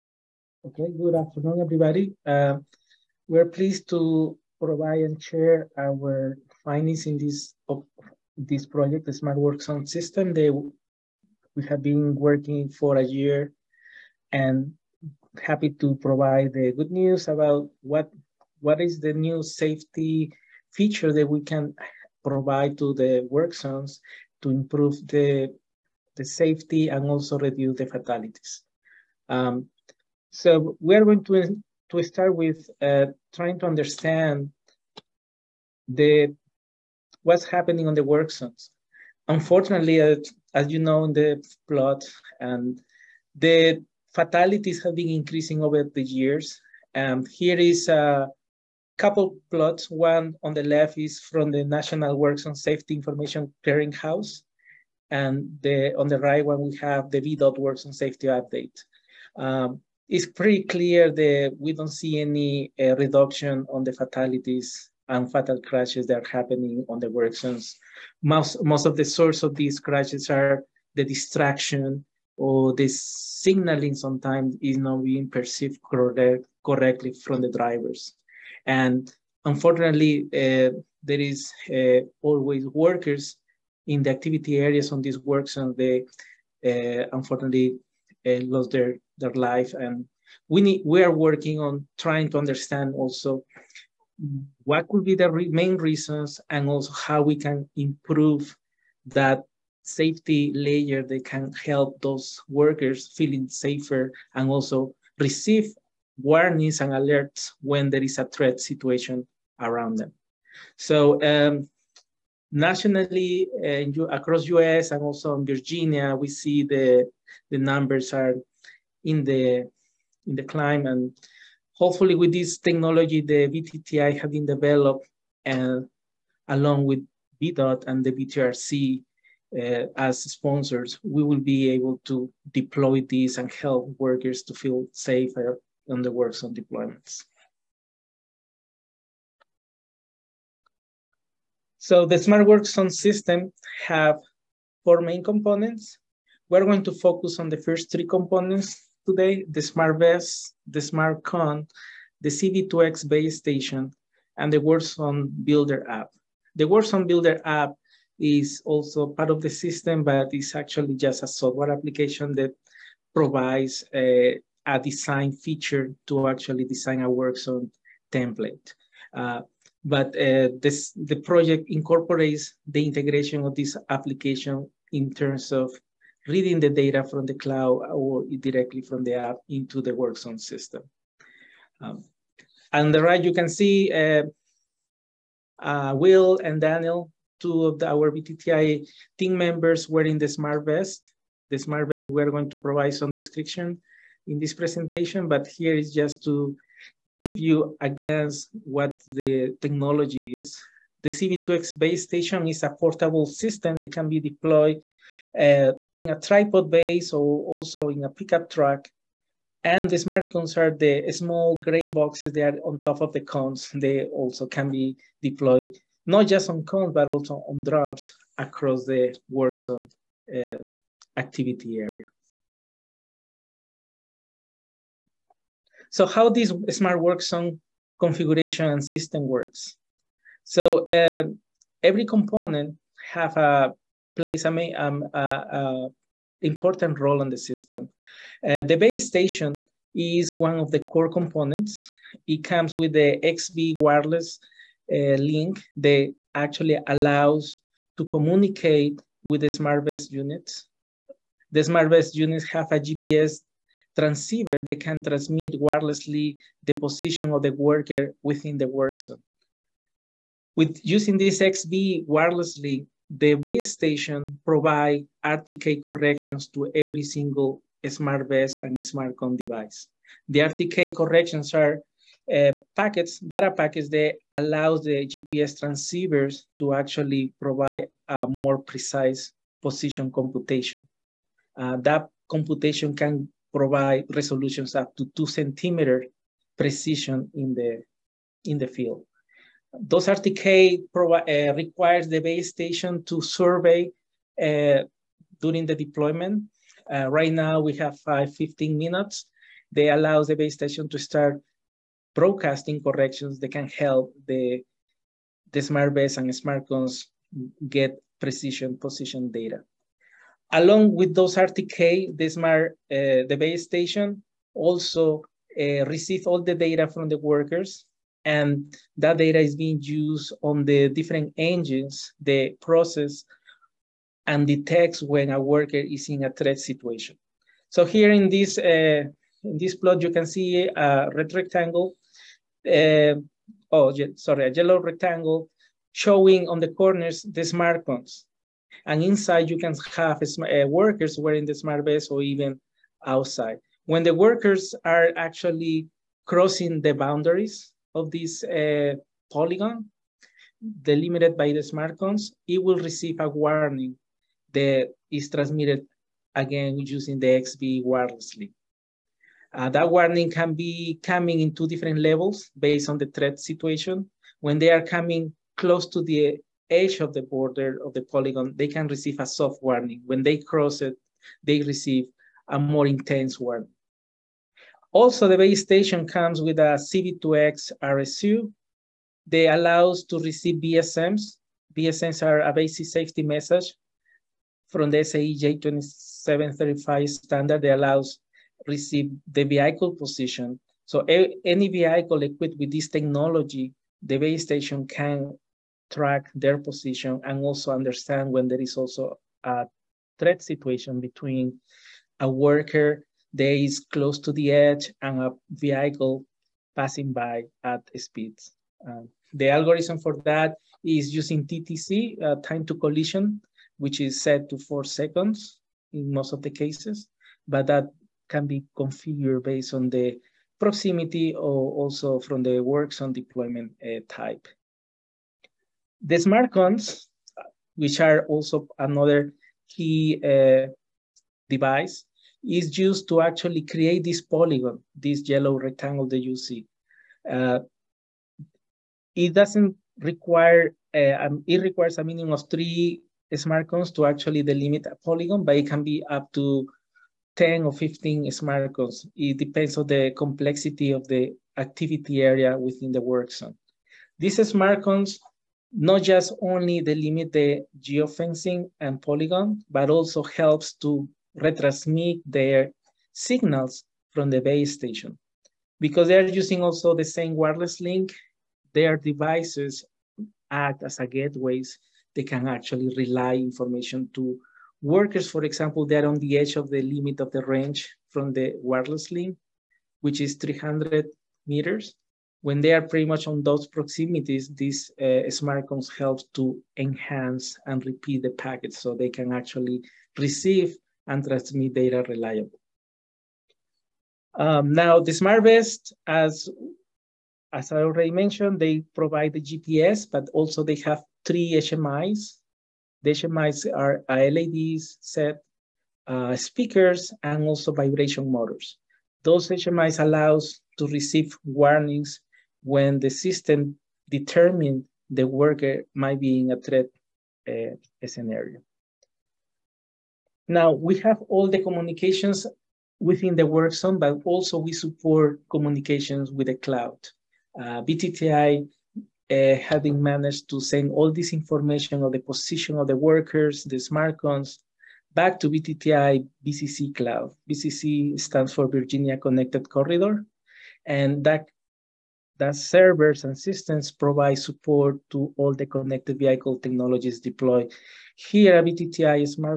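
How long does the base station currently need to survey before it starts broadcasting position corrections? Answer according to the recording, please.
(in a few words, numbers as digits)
15 minutes.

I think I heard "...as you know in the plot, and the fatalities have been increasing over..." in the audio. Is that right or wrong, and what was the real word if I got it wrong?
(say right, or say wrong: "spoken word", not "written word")
right.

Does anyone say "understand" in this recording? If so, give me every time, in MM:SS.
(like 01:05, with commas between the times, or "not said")
00:33, 01:32, 06:37.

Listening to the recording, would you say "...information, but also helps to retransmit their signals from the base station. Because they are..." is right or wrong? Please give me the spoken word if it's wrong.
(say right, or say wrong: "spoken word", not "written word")
wrong: "polygon", not "information".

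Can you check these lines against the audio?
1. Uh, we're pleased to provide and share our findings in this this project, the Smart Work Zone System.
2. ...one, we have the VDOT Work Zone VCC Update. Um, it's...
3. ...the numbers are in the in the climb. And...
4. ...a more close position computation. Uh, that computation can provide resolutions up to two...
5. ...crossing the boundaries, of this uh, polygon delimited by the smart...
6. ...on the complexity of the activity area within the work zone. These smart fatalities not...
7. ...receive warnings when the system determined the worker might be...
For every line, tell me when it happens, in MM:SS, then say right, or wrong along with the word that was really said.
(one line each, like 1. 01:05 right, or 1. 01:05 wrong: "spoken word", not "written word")
1. 00:02 right
2. 00:56 wrong: "Safety", not "VCC"
3. 01:57 right
4. 04:38 wrong: "precise", not "close"
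5. 05:46 right
6. 07:29 wrong: "cones", not "fatalities"
7. 08:30 right.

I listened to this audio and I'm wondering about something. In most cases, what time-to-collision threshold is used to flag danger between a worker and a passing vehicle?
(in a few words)
4 seconds.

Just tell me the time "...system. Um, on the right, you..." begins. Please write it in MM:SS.
03:00.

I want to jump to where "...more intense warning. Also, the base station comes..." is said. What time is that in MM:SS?
06:12.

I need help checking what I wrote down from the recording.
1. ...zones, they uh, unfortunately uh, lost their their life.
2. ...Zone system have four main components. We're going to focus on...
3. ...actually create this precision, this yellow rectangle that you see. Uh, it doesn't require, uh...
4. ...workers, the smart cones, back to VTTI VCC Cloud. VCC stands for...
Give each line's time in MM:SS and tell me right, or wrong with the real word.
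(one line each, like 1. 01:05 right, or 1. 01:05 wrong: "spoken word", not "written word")
1. 01:25 right
2. 02:22 right
3. 07:13 wrong: "polygon", not "precision"
4. 08:52 right.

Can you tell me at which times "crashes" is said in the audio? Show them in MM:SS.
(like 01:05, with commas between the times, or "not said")
01:05, 01:09.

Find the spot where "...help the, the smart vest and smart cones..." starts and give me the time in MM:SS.
05:03.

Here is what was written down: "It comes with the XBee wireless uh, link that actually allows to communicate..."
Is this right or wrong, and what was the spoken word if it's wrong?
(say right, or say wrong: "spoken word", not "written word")
right.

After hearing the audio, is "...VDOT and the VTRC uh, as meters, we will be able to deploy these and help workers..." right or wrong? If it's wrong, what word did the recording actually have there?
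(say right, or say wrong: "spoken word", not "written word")
wrong: "sponsors", not "meters".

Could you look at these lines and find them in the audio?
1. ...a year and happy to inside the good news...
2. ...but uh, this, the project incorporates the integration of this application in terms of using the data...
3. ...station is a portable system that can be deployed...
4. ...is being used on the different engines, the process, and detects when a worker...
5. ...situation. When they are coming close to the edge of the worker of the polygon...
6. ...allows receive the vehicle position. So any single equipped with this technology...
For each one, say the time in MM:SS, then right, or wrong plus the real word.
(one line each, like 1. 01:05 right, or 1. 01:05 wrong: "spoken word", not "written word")
1. 00:12 wrong: "provide", not "inside"
2. 02:49 wrong: "reading", not "using"
3. 03:22 right
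4. 05:19 right
5. 06:03 wrong: "border", not "worker"
6. 06:27 wrong: "vehicle", not "single".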